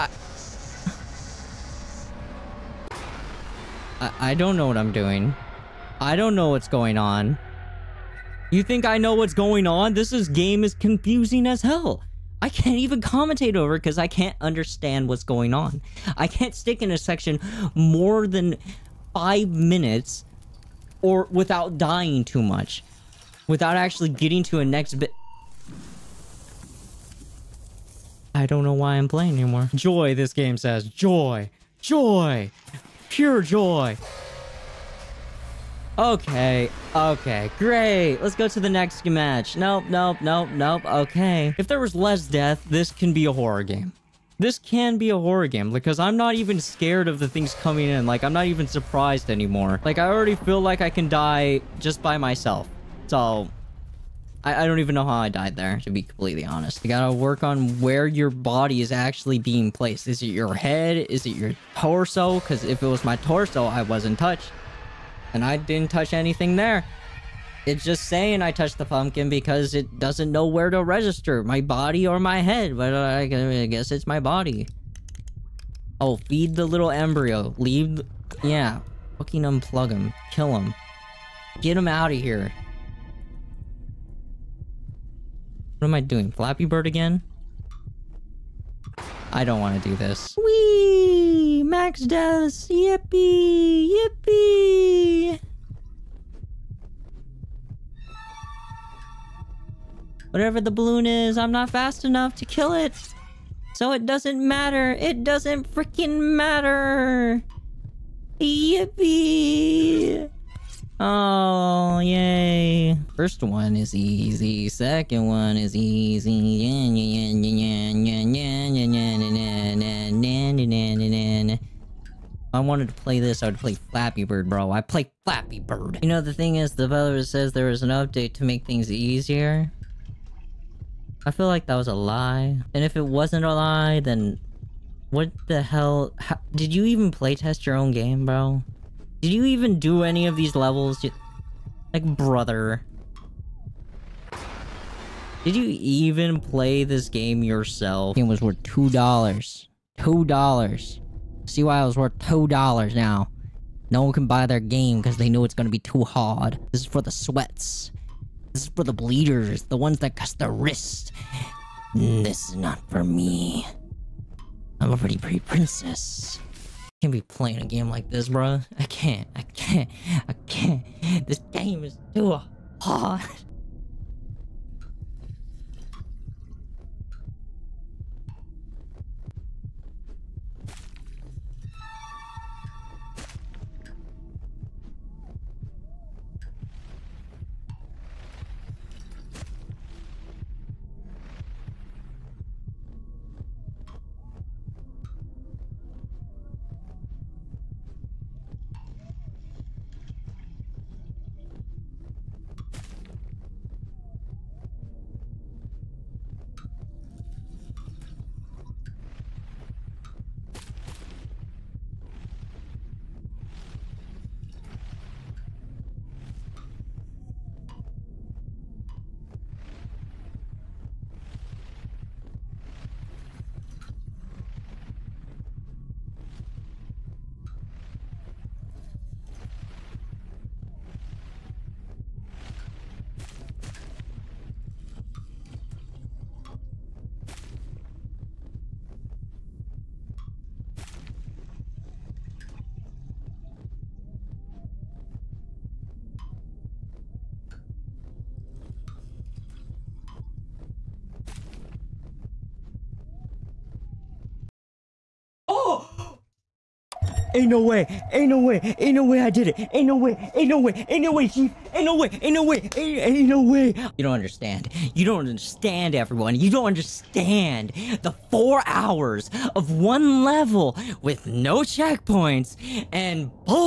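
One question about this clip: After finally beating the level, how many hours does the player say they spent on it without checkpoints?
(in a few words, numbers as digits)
4 hours.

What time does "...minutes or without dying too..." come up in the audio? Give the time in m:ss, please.
0:19.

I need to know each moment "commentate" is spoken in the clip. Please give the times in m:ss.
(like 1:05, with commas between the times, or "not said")
0:13.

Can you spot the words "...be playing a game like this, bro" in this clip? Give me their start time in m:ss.
2:47.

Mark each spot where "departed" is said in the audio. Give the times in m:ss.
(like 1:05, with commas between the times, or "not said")
not said.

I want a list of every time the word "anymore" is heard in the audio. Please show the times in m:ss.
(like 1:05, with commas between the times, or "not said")
0:29, 0:49.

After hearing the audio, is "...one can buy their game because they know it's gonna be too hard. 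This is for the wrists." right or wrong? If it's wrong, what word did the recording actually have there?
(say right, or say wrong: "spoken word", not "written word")
wrong: "sweats", not "wrists".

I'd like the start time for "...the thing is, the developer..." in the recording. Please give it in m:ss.
2:06.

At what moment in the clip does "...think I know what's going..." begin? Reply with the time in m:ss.
0:08.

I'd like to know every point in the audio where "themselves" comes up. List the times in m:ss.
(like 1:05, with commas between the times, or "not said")
not said.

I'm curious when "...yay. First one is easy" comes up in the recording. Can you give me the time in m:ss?
1:51.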